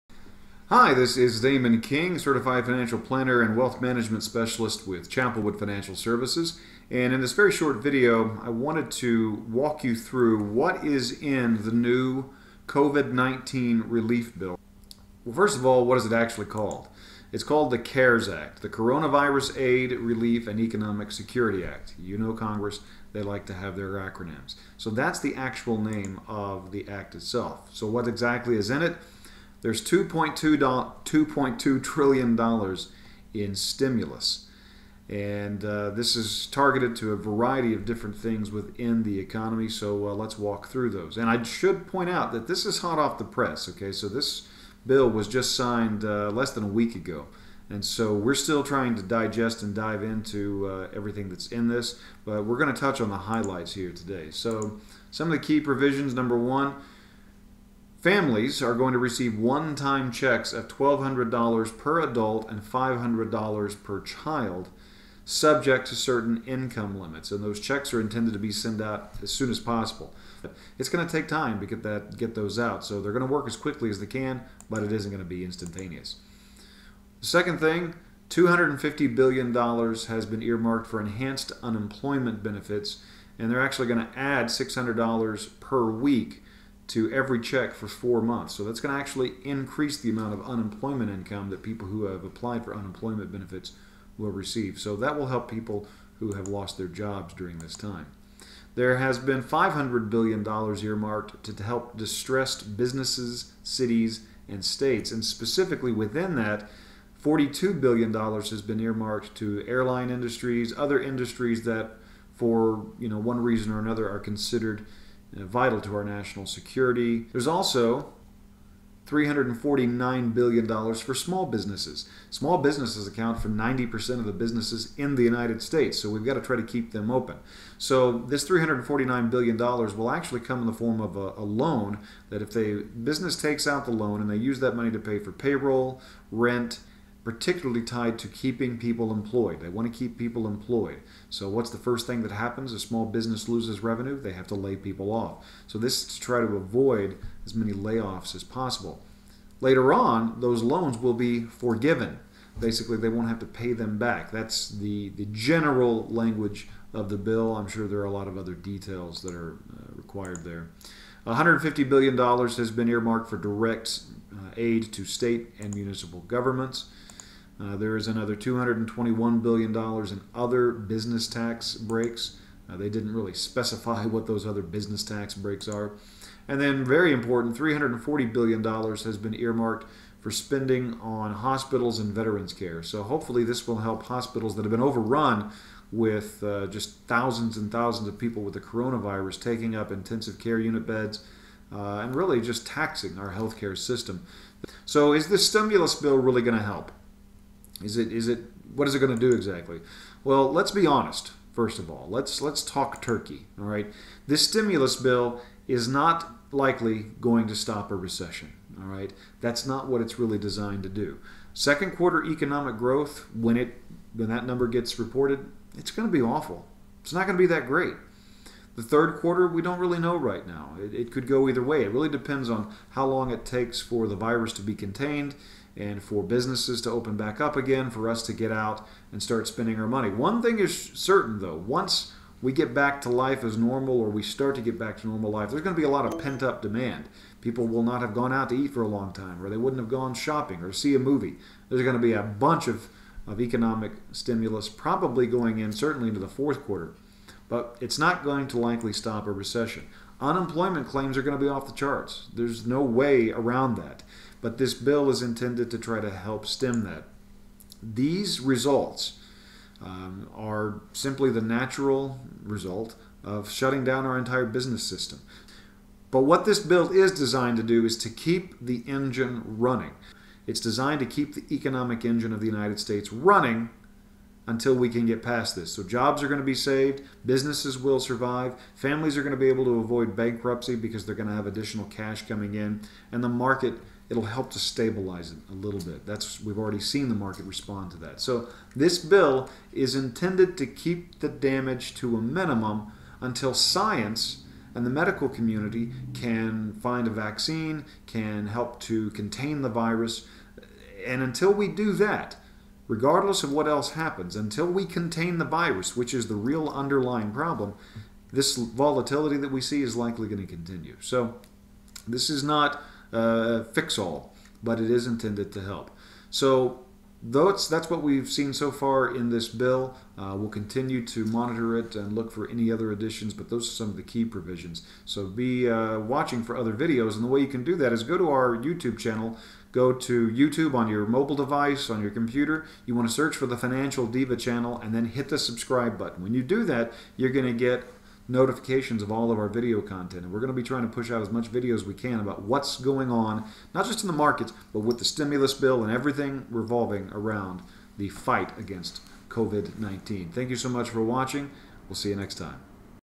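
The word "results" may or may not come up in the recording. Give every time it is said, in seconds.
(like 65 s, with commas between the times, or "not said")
258 s, 262 s.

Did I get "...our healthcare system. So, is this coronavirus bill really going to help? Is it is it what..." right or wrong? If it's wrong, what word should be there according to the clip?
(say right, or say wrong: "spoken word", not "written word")
wrong: "stimulus", not "coronavirus".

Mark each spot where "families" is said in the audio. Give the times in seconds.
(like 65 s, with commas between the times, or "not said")
58 s, 278 s.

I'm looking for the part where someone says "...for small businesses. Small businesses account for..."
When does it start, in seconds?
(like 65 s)
120 s.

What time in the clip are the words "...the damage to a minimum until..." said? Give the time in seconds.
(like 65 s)
291 s.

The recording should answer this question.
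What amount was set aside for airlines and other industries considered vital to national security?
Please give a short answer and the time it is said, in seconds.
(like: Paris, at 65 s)
$42 billion, at 107 s.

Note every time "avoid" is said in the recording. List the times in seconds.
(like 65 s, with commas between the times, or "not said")
146 s, 279 s.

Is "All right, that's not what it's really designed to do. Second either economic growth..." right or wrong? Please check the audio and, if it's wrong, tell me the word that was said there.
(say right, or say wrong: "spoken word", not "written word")
wrong: "quarter", not "either".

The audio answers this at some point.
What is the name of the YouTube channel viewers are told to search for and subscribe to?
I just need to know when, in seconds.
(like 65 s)
333 s.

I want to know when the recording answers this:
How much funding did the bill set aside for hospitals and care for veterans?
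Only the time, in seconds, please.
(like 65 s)
177 s.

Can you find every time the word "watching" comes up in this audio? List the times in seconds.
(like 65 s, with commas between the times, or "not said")
325 s, 351 s.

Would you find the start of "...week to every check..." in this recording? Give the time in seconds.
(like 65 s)
85 s.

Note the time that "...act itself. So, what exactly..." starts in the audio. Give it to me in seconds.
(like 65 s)
26 s.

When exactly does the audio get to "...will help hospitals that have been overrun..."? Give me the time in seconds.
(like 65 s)
183 s.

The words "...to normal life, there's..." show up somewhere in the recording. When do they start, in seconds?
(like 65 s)
235 s.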